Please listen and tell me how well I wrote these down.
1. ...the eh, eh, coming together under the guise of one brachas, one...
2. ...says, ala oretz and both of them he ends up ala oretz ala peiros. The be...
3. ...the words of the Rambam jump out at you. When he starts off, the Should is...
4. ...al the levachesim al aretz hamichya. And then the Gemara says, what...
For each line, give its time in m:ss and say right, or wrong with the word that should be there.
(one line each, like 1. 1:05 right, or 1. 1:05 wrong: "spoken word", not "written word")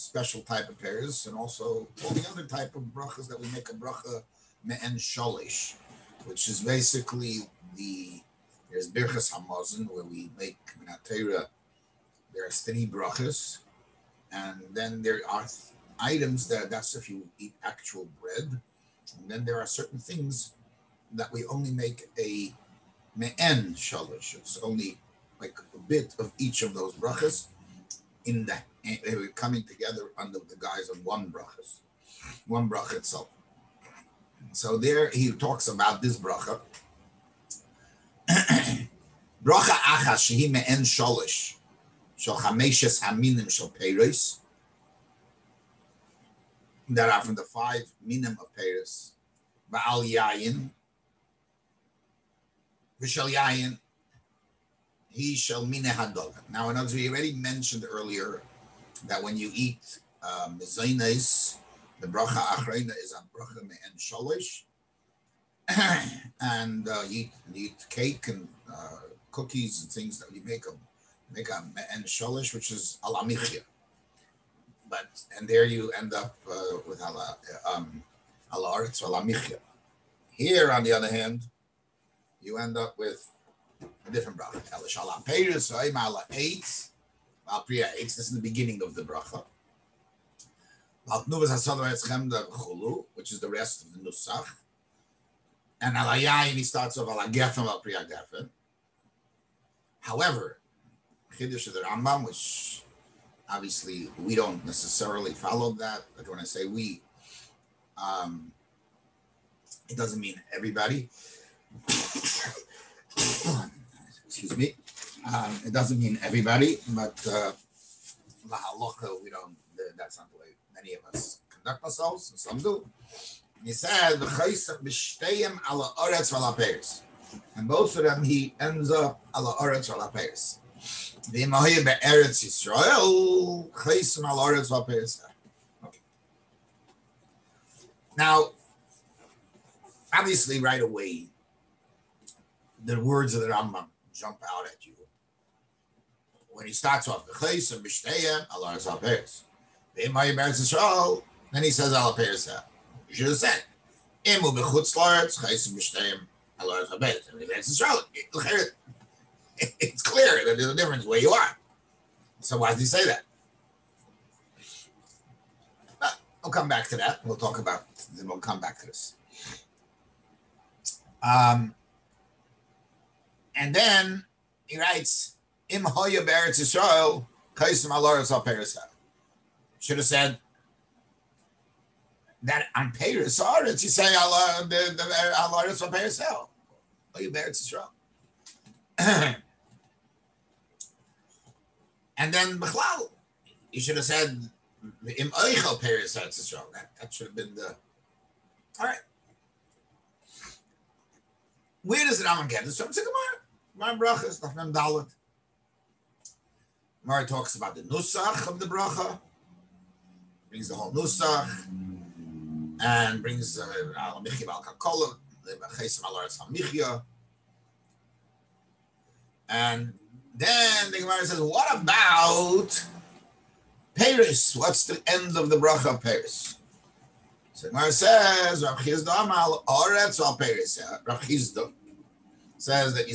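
1. 0:28 right
2. 2:03 right
3. 2:22 wrong: "Allah", not "Should"
4. 3:34 right.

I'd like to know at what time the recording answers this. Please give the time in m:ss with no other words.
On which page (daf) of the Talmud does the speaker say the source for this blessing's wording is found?
3:24.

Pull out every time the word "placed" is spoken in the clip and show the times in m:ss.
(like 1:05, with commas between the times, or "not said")
not said.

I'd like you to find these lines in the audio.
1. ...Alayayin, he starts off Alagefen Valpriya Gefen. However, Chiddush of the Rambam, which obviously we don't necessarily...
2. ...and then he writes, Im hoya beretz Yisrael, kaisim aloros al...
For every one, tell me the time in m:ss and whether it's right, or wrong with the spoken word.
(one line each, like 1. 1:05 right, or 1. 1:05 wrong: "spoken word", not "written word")
1. 1:35 right
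2. 2:53 right.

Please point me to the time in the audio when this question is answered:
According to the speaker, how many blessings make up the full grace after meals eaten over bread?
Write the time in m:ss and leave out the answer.
0:12.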